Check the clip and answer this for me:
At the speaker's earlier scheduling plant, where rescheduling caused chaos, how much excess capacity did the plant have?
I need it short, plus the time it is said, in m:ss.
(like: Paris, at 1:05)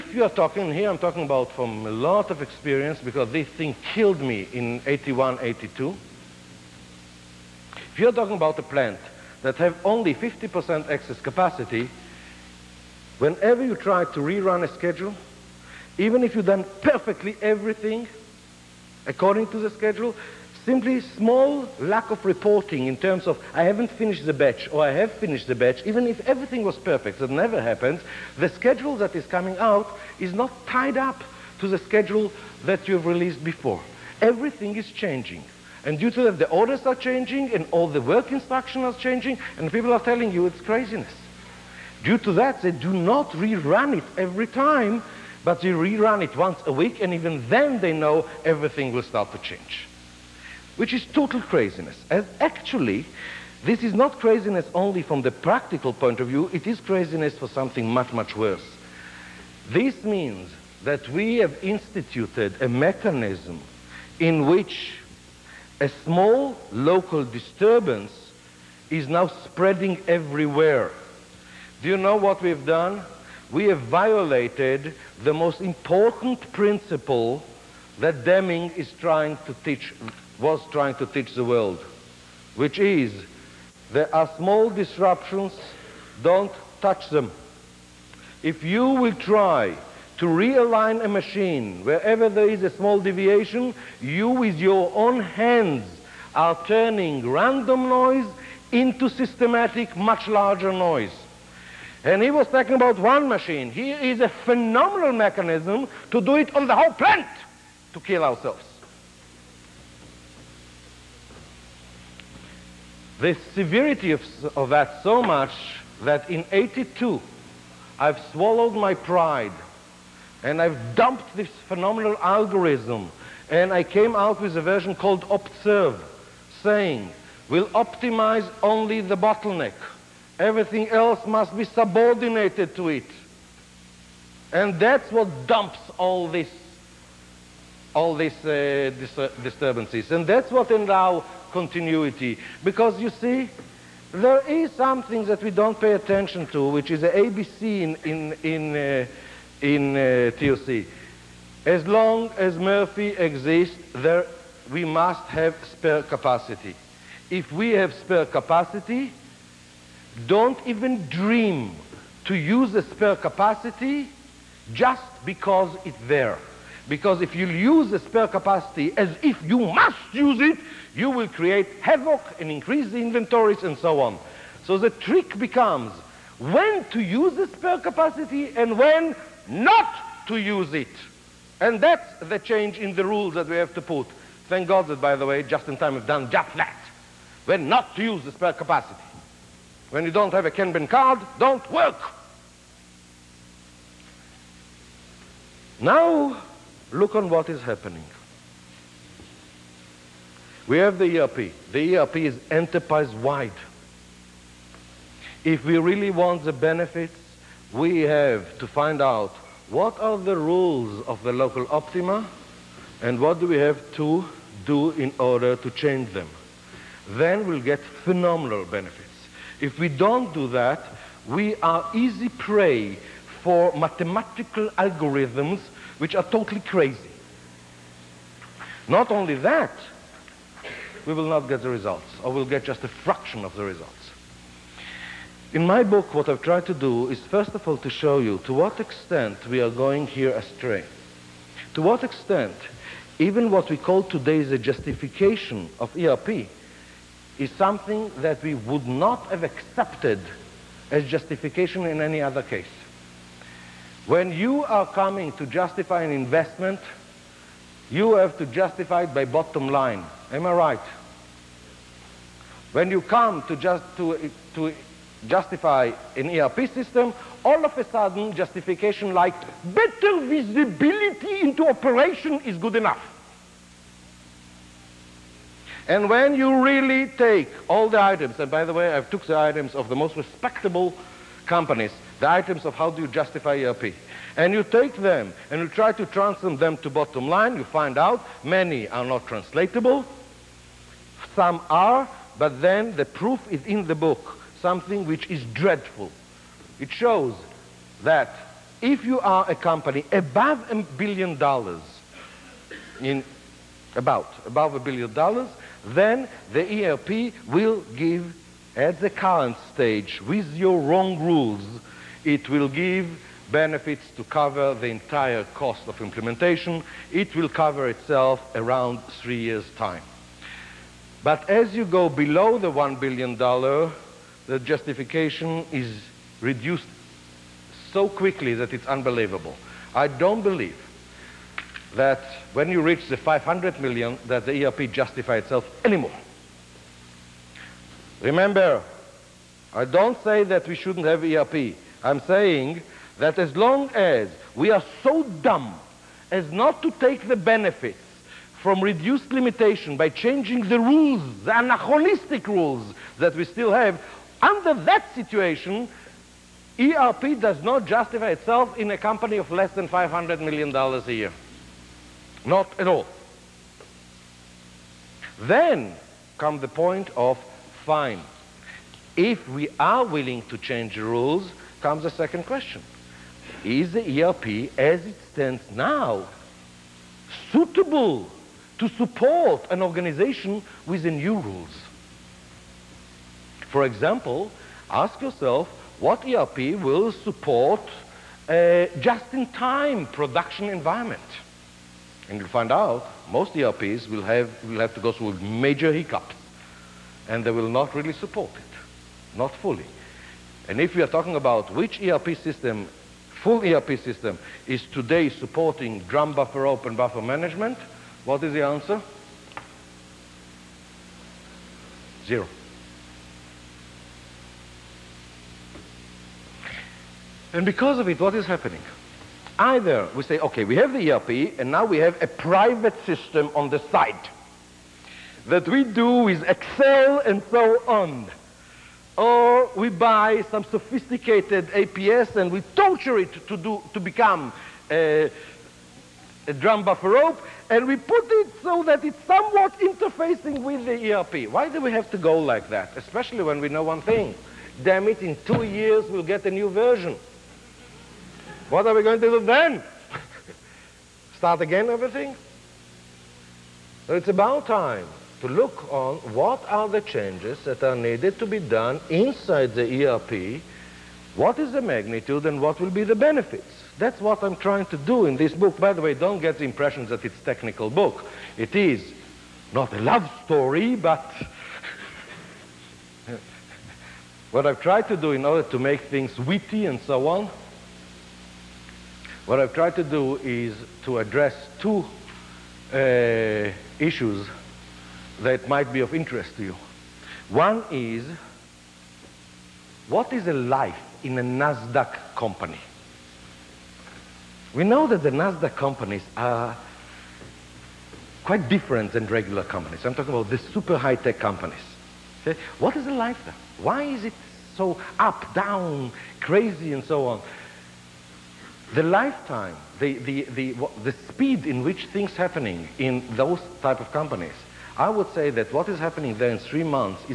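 50%, at 0:10.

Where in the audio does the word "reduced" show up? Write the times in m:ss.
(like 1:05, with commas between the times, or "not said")
5:26, 5:48.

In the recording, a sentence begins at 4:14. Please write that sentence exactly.
When you are coming to justify an investment, you have to justify it by bottom line.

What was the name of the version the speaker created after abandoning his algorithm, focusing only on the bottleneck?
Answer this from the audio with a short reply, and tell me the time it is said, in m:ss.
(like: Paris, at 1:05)
Observe, at 2:05.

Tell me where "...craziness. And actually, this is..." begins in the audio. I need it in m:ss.
0:51.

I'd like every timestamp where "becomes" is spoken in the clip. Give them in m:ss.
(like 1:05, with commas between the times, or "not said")
2:55, 7:14.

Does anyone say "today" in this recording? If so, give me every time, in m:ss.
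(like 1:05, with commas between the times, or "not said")
4:04, 6:44.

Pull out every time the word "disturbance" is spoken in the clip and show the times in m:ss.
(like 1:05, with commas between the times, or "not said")
1:07, 2:19.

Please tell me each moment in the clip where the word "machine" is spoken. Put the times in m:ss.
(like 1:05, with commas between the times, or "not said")
1:31, 1:43.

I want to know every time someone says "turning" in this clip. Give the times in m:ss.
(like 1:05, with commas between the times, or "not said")
1:36.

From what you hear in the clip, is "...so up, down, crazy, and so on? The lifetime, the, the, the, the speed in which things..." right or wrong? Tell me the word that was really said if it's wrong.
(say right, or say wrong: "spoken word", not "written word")
right.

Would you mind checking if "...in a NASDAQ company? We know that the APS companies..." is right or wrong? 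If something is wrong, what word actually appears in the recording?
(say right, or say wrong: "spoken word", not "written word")
wrong: "NASDAQ", not "APS".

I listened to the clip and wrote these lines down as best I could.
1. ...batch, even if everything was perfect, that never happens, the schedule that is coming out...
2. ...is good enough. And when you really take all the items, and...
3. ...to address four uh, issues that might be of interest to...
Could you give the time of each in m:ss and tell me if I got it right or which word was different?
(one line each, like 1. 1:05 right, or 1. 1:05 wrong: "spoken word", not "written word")
1. 0:25 right
2. 4:32 right
3. 8:01 wrong: "two", not "four".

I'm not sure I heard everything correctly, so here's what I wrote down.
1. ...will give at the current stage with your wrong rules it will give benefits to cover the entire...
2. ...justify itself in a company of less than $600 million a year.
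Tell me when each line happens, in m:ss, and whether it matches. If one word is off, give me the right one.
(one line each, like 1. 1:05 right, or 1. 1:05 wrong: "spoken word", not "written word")
1. 5:07 right
2. 5:57 wrong: "500", not "600".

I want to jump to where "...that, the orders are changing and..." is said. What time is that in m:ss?
0:36.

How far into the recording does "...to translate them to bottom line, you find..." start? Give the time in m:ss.
4:45.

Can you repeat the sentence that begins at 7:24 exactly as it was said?
Damn it, in two years we'll get a new version.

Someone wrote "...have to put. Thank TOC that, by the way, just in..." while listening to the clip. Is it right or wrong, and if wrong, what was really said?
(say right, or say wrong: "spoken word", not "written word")
wrong: "God", not "TOC".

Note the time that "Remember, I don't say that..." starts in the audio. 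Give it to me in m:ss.
5:38.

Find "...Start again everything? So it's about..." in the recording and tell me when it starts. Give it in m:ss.
7:31.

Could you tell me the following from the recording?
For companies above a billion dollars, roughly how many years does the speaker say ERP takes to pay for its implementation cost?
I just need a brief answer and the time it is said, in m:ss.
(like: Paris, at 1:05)
3 years, at 5:19.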